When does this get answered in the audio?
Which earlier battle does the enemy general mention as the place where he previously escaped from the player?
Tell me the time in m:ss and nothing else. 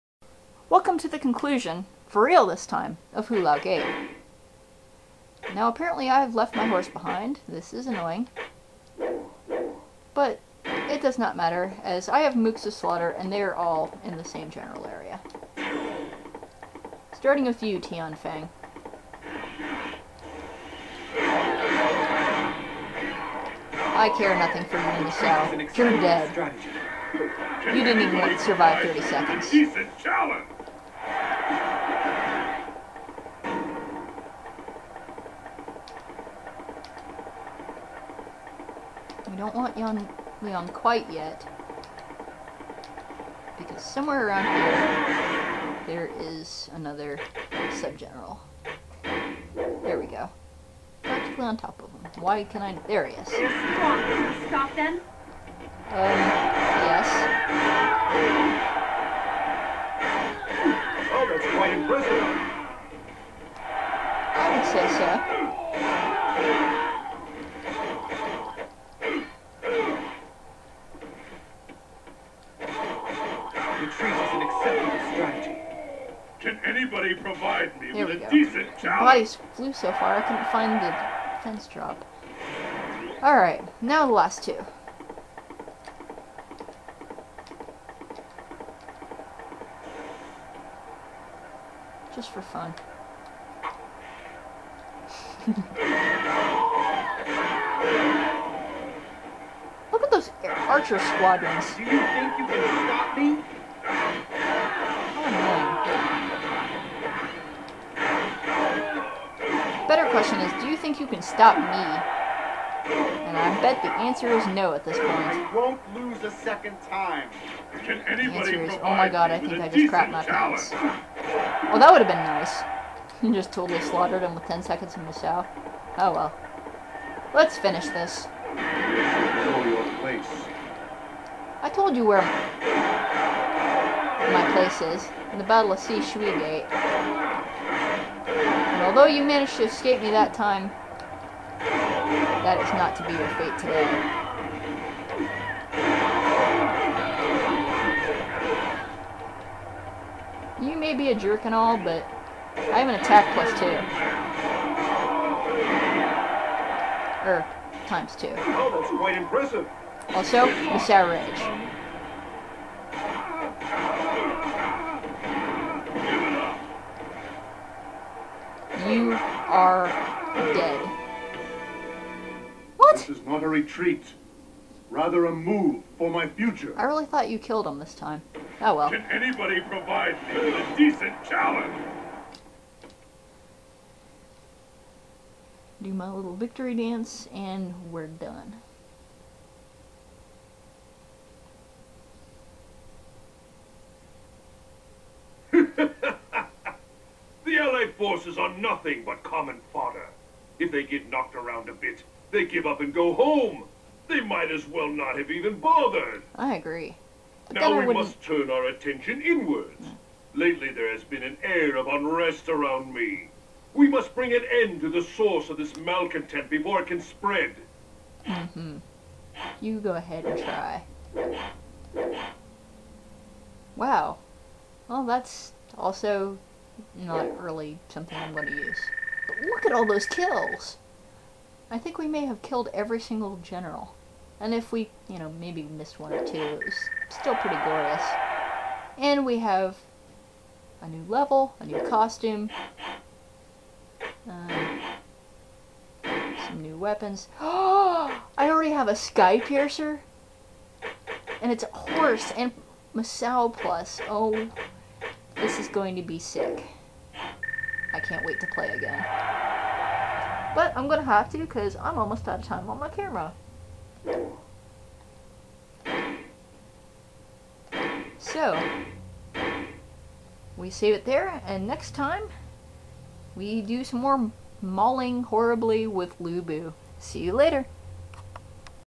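2:15.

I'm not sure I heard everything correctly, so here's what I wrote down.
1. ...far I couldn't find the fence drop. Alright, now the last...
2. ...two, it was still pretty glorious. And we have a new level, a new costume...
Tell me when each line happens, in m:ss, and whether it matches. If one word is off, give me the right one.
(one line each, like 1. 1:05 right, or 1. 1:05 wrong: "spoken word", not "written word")
1. 1:19 right
2. 3:56 right.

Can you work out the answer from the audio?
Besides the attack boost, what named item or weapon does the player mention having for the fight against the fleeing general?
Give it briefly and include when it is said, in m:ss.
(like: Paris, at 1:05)
Sour Edge, at 2:40.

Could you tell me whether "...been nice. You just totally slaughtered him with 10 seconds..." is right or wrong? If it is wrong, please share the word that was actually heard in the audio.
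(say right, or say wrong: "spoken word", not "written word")
right.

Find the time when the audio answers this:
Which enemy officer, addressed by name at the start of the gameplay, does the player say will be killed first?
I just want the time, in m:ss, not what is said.
0:17.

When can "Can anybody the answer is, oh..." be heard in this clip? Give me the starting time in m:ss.
1:57.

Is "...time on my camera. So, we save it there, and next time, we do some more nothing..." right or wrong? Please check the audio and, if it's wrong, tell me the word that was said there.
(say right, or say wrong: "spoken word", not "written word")
wrong: "mauling", not "nothing".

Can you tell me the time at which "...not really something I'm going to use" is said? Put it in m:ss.
3:46.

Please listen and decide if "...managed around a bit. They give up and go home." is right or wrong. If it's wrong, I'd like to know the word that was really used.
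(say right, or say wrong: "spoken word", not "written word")
wrong: "knocked", not "managed".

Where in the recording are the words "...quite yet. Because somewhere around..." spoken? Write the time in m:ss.
0:40.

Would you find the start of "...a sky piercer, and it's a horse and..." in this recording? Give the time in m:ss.
4:08.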